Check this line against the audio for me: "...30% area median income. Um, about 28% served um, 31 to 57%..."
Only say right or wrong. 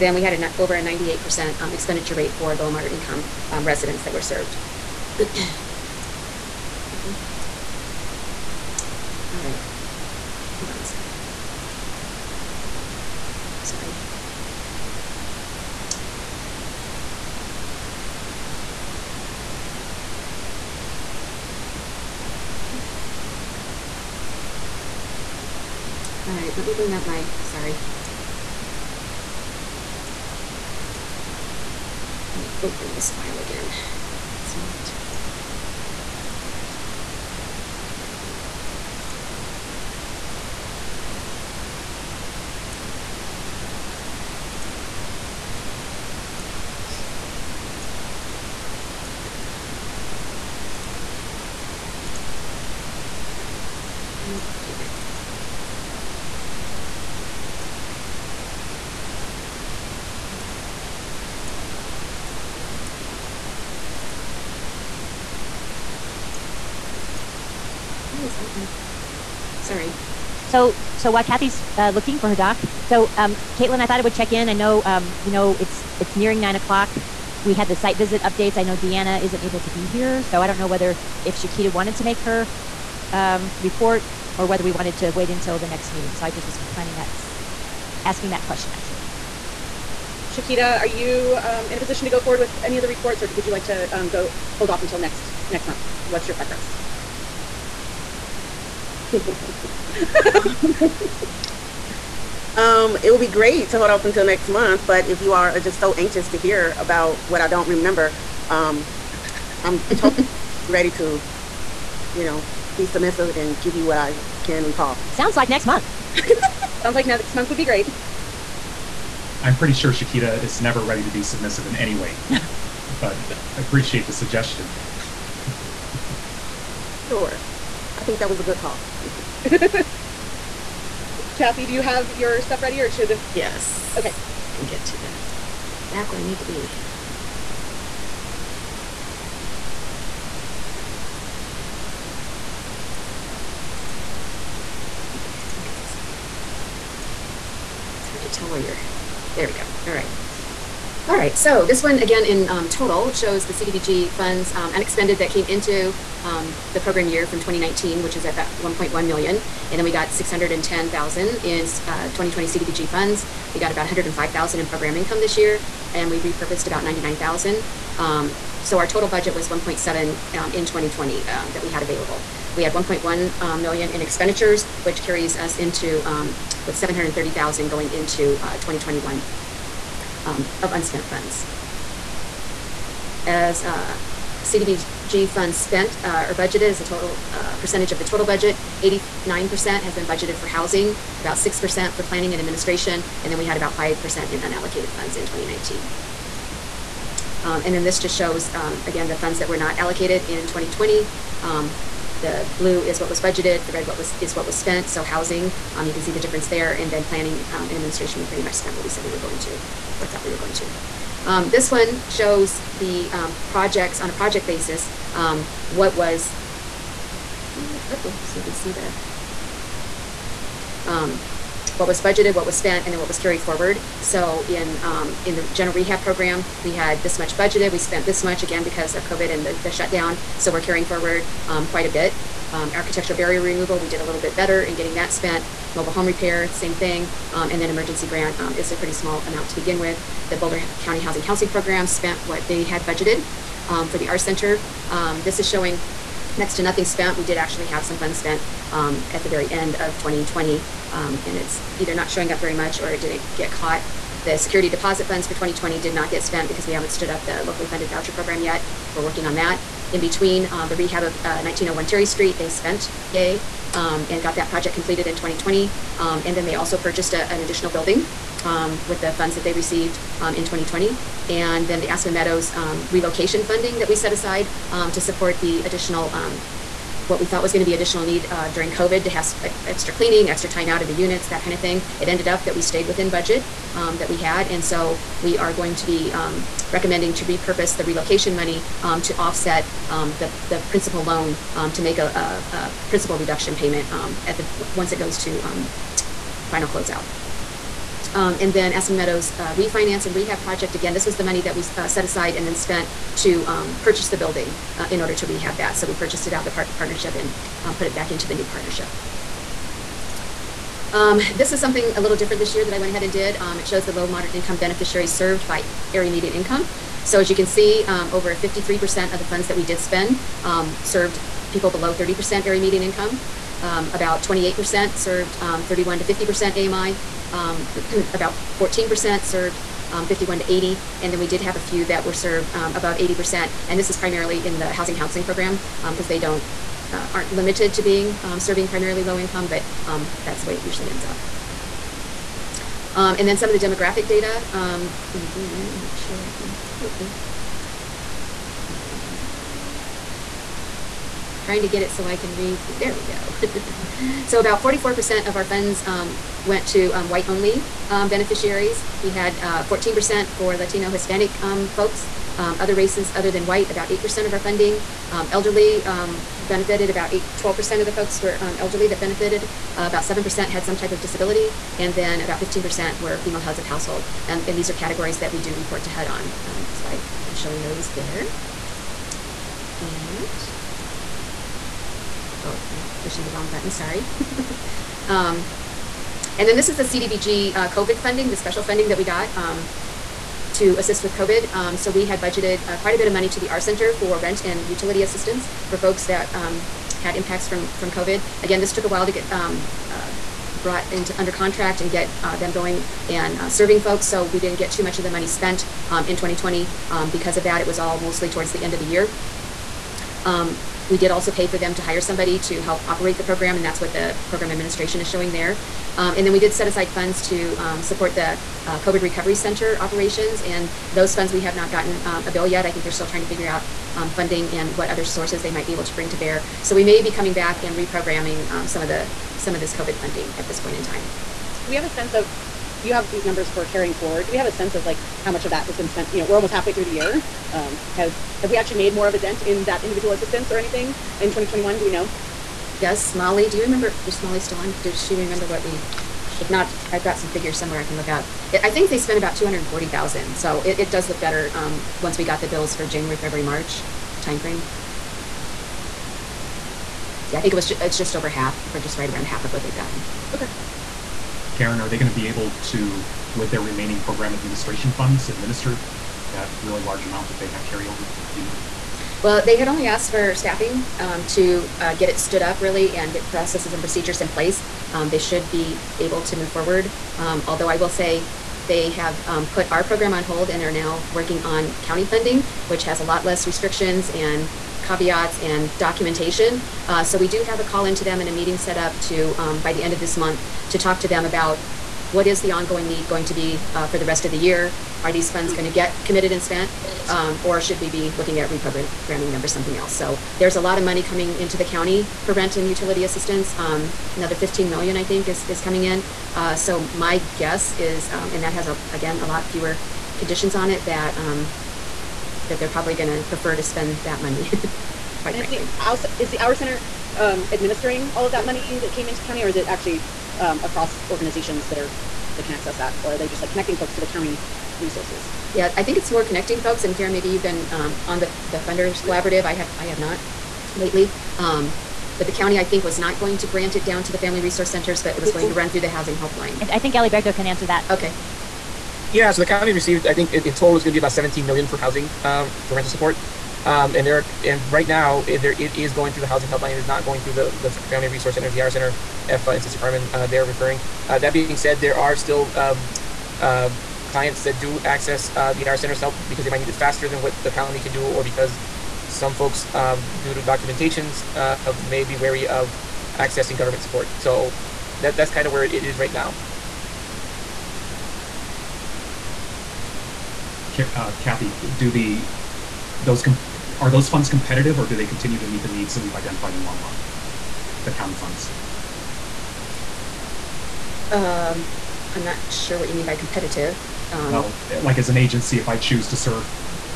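wrong.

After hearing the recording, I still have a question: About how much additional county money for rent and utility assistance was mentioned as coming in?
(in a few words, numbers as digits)
15 million.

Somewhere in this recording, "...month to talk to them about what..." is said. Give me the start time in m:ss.
8:10.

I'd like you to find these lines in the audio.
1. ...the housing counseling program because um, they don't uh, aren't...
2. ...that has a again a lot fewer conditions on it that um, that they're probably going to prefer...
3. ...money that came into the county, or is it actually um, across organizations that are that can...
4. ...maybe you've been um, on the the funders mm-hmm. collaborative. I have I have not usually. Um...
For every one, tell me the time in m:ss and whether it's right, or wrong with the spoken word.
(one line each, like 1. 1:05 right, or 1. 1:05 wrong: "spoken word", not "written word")
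1. 5:34 right
2. 8:28 right
3. 8:38 right
4. 8:47 wrong: "lately", not "usually".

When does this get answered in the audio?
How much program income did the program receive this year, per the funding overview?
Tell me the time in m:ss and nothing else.
2:43.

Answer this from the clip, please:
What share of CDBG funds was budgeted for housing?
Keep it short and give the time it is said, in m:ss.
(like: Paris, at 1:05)
89%, at 3:08.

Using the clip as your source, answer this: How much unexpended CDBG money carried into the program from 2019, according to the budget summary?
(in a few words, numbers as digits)
about 1.1 million.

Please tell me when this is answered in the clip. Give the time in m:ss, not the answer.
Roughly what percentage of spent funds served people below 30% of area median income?
5:18.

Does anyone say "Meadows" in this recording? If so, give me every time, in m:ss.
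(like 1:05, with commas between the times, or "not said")
4:32, 4:58.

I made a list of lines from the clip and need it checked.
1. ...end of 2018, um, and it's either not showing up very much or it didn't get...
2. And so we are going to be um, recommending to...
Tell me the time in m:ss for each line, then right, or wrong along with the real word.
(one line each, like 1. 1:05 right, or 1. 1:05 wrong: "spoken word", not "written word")
1. 4:09 wrong: "2020", not "2018"
2. 4:44 right.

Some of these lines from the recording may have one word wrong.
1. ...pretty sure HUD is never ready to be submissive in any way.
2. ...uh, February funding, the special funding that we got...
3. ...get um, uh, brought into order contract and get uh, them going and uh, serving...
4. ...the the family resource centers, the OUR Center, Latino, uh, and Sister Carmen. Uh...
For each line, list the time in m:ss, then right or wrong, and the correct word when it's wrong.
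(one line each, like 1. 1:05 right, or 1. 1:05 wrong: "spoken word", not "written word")
1. 1:59 wrong: "Shakita", not "HUD"
2. 6:27 wrong: "COVID", not "February"
3. 6:39 wrong: "under", not "order"
4. 9:07 wrong: "EFA", not "Latino".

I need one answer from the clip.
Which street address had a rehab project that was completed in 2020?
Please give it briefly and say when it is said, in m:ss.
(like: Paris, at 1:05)
1901 Terry Street, at 4:21.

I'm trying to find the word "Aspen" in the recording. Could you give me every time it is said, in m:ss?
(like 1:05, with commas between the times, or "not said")
4:31, 4:58.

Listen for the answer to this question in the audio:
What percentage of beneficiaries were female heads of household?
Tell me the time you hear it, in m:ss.
6:12.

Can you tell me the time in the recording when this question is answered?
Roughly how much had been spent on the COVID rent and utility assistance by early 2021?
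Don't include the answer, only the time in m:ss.
7:29.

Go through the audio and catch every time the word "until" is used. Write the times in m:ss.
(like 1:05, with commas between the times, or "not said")
1:25, 1:34, 1:44.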